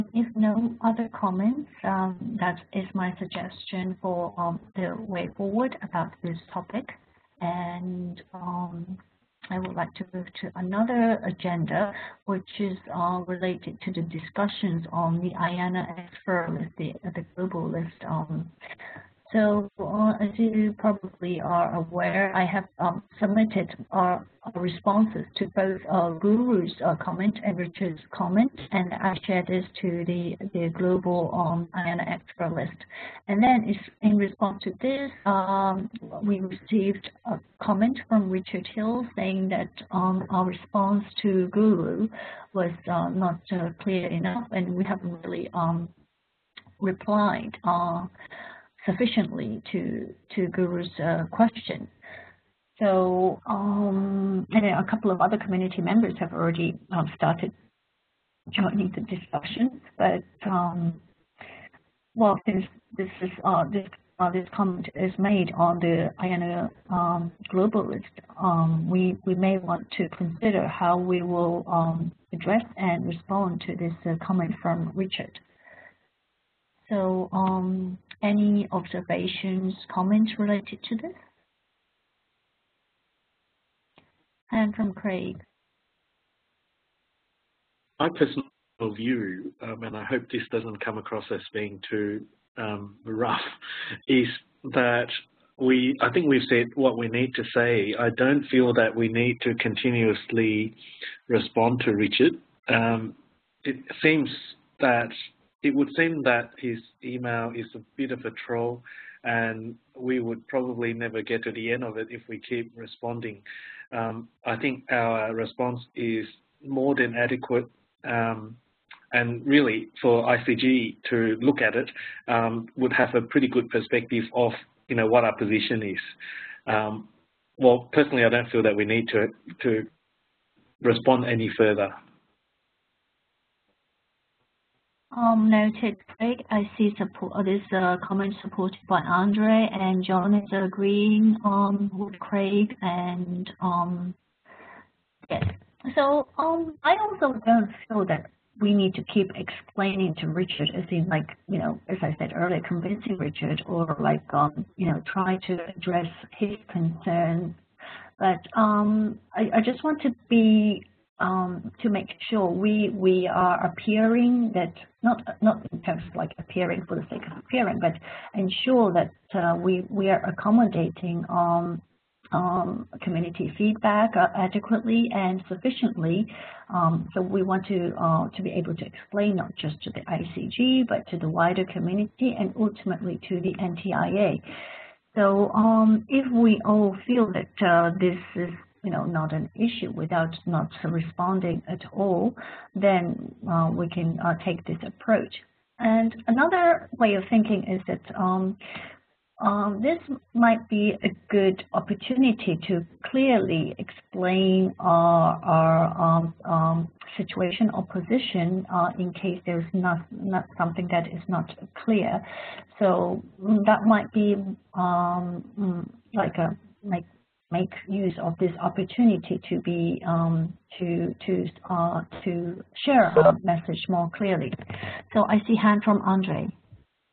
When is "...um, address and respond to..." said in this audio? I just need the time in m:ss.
1:11.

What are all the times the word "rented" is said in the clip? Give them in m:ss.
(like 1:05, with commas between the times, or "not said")
not said.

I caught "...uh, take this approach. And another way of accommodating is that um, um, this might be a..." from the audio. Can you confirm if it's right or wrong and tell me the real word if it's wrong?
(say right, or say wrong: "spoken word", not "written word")
wrong: "thinking", not "accommodating".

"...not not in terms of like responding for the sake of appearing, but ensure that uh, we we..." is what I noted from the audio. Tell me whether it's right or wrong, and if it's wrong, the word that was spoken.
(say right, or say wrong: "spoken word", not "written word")
wrong: "appearing", not "responding".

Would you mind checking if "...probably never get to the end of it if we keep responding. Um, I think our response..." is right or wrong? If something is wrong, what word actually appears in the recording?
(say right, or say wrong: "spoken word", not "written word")
right.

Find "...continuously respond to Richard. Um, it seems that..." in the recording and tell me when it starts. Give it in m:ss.
1:39.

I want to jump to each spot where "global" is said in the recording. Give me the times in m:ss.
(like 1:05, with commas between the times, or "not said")
0:17, 0:30.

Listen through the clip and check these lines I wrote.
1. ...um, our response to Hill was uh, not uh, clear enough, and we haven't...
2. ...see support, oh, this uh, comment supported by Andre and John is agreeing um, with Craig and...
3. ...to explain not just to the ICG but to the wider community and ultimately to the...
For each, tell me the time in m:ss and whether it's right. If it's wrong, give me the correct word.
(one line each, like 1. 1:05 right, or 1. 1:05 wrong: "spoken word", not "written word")
1. 0:39 wrong: "Guru", not "Hill"
2. 2:16 right
3. 2:58 right.